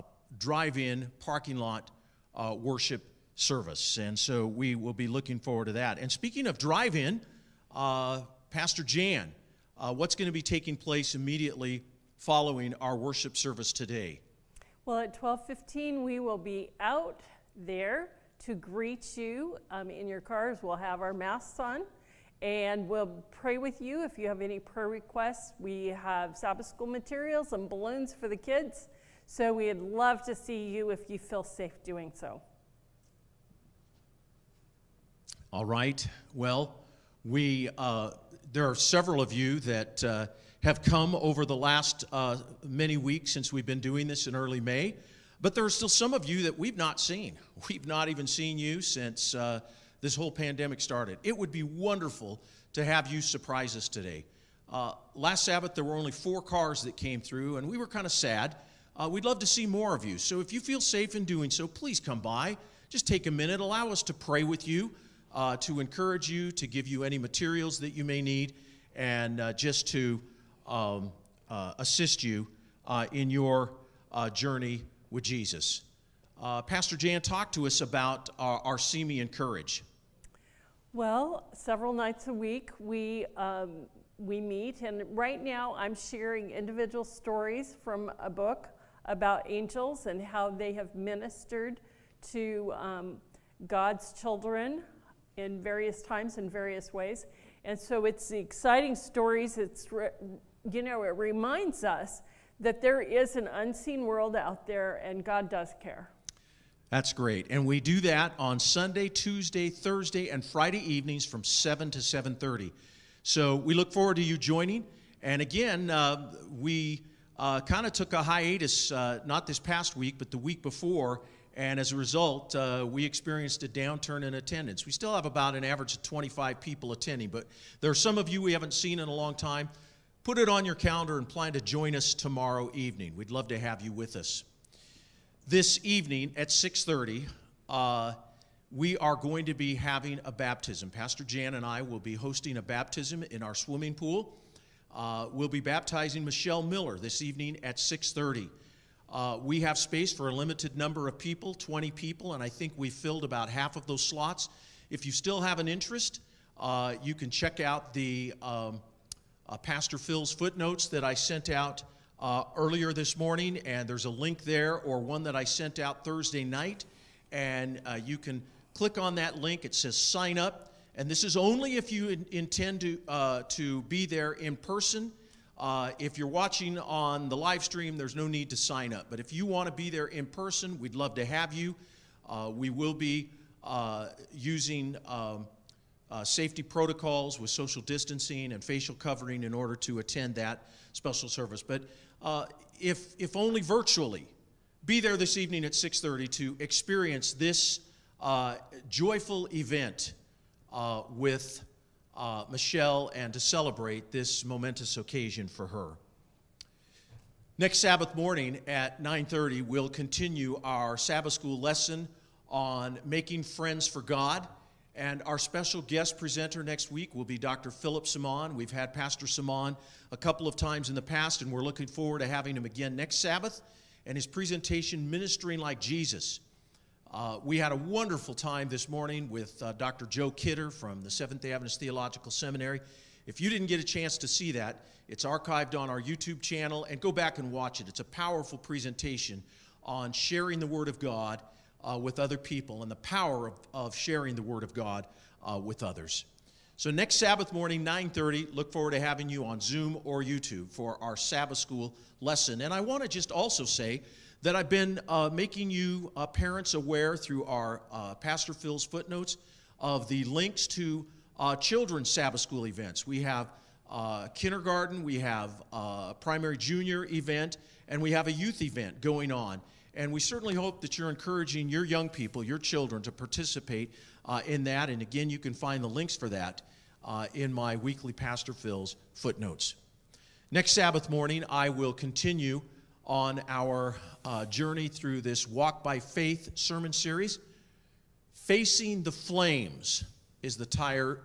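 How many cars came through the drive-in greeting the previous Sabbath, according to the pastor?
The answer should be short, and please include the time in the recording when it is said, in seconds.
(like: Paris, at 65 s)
4, at 56 s.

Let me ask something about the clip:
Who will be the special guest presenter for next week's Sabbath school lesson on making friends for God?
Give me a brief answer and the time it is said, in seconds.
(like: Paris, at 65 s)
Dr. Philip Simon, at 217 s.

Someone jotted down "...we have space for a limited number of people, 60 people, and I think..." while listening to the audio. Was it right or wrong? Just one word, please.
wrong.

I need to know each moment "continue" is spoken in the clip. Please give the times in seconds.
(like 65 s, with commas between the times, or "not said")
209 s, 281 s.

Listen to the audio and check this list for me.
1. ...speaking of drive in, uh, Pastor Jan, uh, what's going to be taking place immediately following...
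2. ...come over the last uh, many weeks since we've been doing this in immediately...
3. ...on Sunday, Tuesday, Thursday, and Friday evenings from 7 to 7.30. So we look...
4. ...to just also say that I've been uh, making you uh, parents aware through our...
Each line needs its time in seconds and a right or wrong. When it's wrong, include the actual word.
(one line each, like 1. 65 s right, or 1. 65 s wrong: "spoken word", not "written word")
1. 6 s right
2. 40 s wrong: "early", not "immediately"
3. 108 s right
4. 253 s right.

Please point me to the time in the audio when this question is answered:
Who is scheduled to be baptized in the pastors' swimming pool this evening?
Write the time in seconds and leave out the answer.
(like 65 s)
146 s.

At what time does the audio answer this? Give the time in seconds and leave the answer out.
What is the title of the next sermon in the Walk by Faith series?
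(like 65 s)
288 s.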